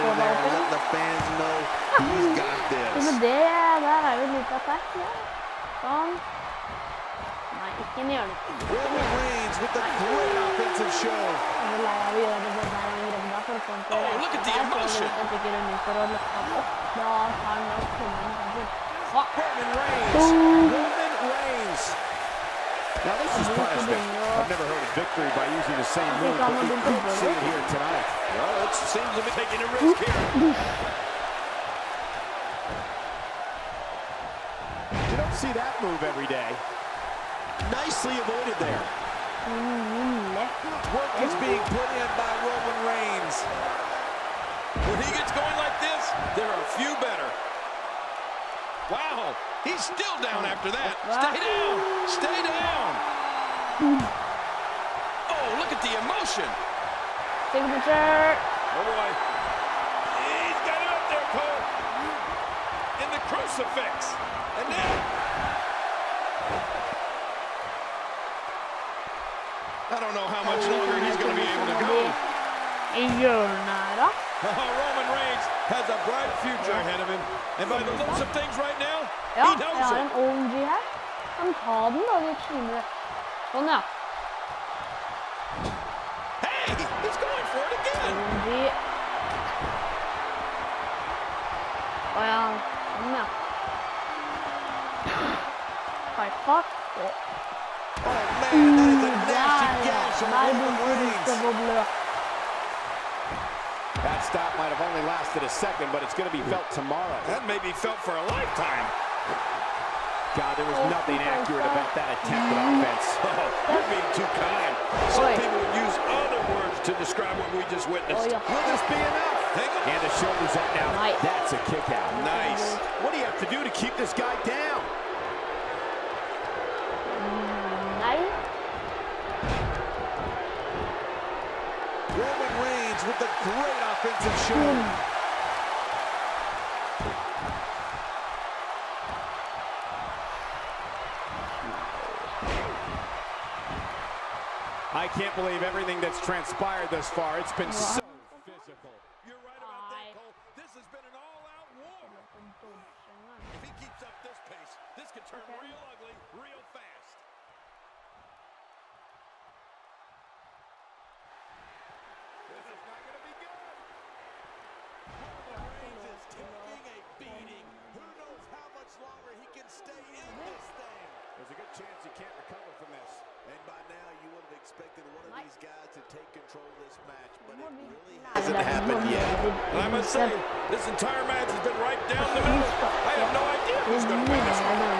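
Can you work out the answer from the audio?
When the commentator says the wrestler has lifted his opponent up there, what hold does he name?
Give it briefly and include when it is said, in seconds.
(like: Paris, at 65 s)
Crucifix, at 63 s.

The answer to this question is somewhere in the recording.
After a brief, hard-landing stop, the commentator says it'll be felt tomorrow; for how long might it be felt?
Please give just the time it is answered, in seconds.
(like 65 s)
108 s.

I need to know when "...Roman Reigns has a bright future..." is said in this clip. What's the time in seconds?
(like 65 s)
74 s.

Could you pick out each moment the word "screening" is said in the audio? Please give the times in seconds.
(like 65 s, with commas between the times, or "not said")
not said.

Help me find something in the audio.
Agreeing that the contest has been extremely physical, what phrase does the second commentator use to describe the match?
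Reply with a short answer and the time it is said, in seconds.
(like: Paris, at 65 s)
An all-out war, at 151 s.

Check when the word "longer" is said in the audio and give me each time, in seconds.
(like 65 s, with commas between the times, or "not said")
70 s, 168 s.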